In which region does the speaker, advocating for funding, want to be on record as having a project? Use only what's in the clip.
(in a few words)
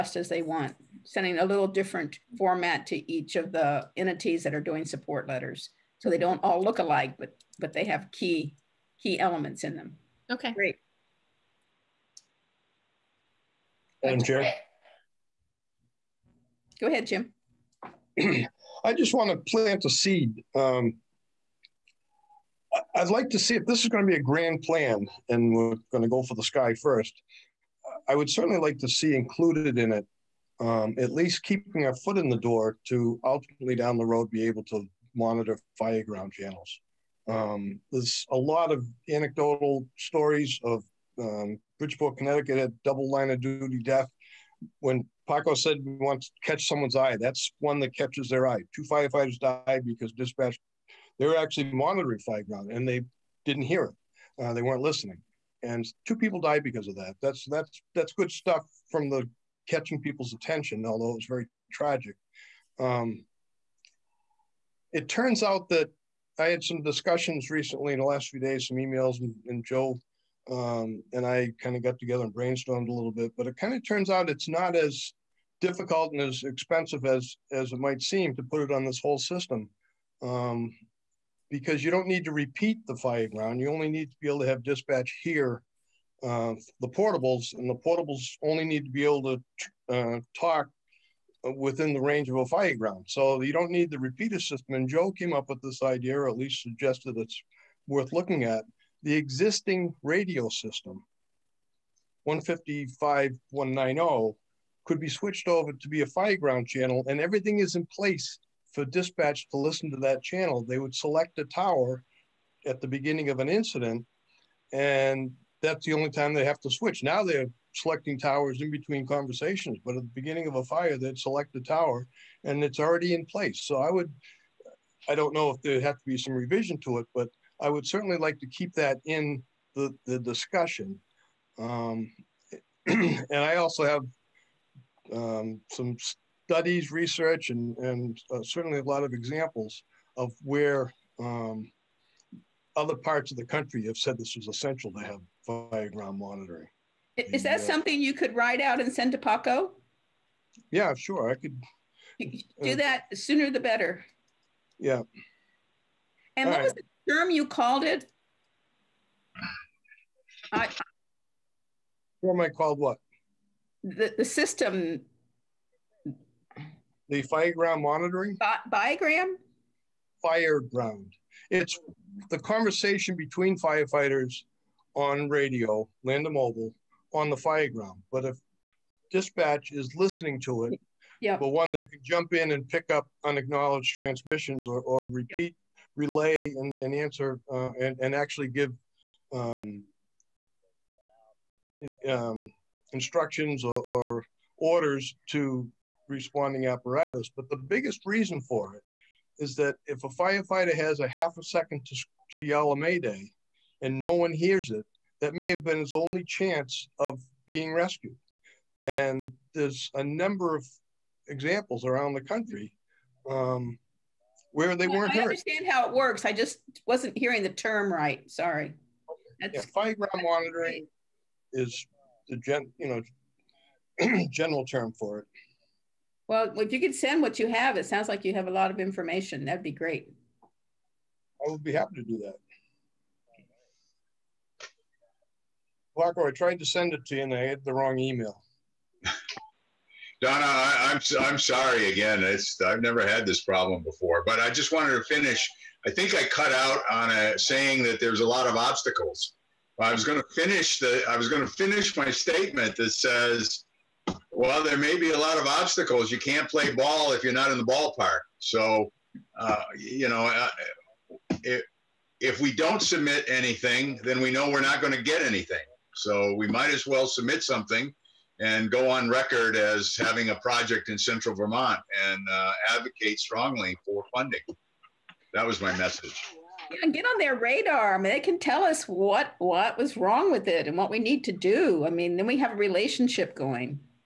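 central Vermont.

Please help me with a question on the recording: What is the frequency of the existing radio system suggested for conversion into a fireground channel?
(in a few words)
155190.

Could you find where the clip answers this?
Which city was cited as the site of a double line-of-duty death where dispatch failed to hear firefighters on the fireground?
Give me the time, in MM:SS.
00:41.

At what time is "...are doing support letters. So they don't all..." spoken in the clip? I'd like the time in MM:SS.
00:04.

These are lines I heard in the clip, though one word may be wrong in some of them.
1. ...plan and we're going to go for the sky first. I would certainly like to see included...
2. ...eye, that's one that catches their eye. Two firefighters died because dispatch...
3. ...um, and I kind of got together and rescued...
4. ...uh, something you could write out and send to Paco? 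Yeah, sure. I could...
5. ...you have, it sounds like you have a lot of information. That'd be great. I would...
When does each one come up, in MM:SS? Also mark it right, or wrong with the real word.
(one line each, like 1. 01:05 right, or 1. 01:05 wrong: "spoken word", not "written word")
1. 00:24 right
2. 00:46 right
3. 01:10 wrong: "brainstormed", not "rescued"
4. 02:27 right
5. 03:47 right.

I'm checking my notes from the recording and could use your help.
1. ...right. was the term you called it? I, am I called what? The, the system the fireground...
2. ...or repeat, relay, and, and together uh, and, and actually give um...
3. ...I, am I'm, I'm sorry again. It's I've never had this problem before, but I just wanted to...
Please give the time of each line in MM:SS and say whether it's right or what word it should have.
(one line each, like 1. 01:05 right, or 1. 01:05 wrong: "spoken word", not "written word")
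1. 02:36 right
2. 03:04 wrong: "answer", not "together"
3. 04:00 right.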